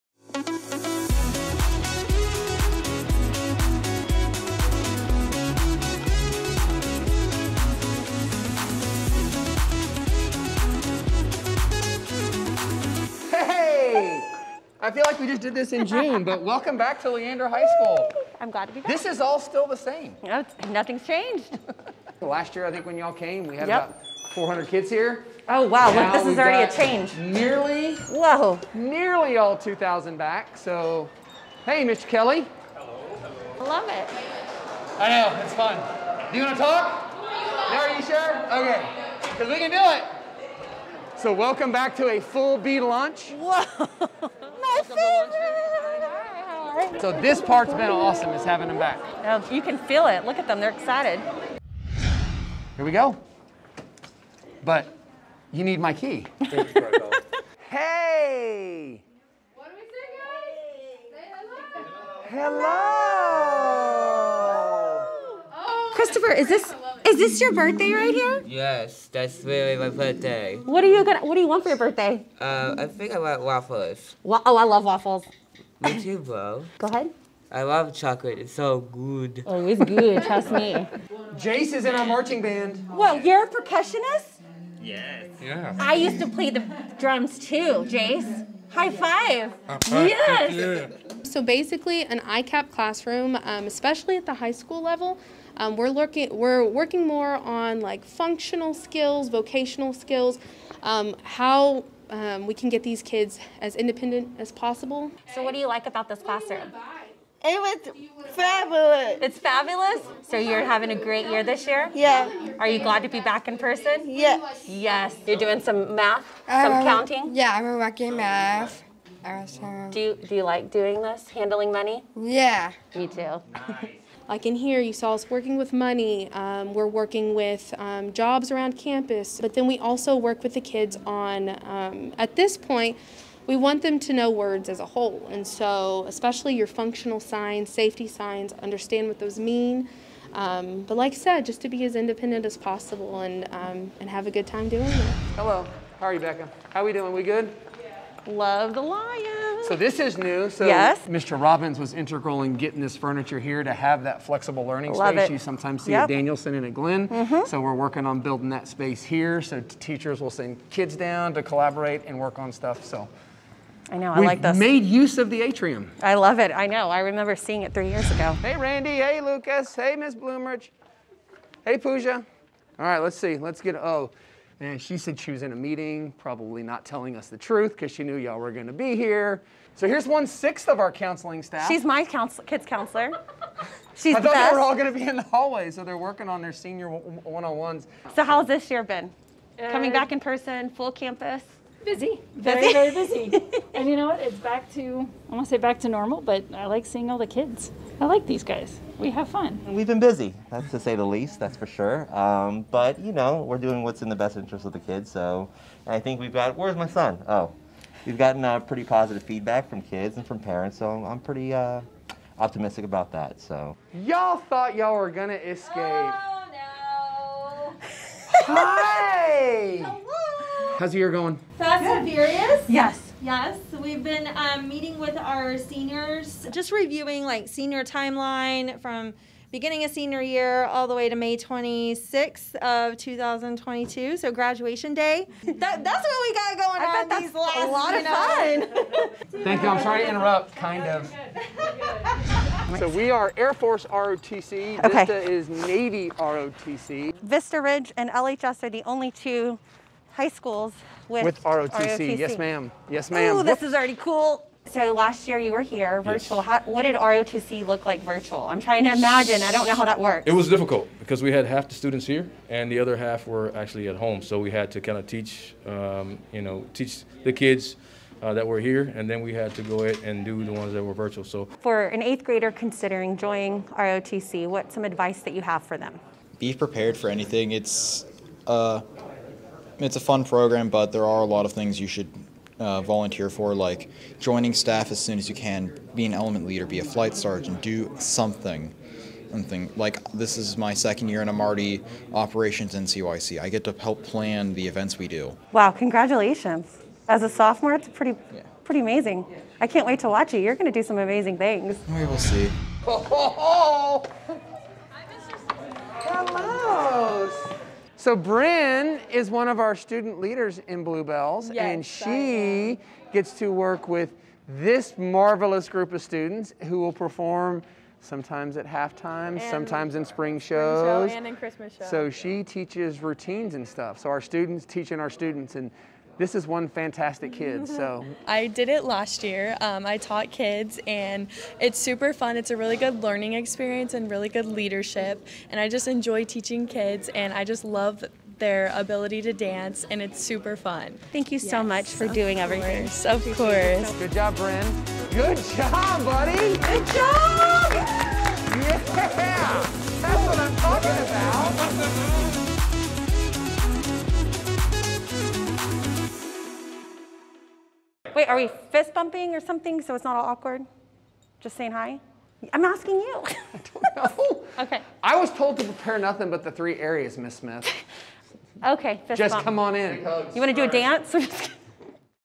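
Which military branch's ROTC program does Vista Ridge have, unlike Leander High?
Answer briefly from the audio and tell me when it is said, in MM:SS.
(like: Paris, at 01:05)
Navy, at 04:05.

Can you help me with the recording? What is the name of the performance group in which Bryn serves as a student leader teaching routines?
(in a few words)
Bluebells.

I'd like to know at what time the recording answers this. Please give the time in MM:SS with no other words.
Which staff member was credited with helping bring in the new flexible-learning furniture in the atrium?
02:31.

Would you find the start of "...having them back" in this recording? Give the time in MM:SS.
00:48.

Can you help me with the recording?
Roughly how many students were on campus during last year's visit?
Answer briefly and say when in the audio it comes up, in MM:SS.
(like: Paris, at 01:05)
400, at 00:23.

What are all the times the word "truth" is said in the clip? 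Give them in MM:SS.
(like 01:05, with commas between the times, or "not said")
02:57.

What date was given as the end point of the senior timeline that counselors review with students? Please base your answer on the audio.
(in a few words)
May 26, 2022.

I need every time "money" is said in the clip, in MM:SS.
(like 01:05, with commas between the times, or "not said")
02:01, 02:05.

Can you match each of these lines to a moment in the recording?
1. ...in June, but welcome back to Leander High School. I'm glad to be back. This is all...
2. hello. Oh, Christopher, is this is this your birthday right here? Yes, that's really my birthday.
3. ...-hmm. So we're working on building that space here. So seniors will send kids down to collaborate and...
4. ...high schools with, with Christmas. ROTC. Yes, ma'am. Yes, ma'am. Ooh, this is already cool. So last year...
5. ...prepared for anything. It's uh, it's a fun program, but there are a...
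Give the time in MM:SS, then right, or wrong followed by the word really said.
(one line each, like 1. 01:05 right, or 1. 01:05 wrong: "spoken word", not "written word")
1. 00:15 right
2. 01:05 right
3. 02:37 wrong: "teachers", not "seniors"
4. 04:10 wrong: "ROTC", not "Christmas"
5. 04:36 right.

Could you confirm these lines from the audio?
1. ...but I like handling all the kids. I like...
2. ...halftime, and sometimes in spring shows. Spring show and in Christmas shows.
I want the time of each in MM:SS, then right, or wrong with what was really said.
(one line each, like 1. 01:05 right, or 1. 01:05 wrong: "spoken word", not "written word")
1. 03:16 wrong: "seeing", not "handling"
2. 05:18 right.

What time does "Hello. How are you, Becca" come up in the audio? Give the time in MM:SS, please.
02:25.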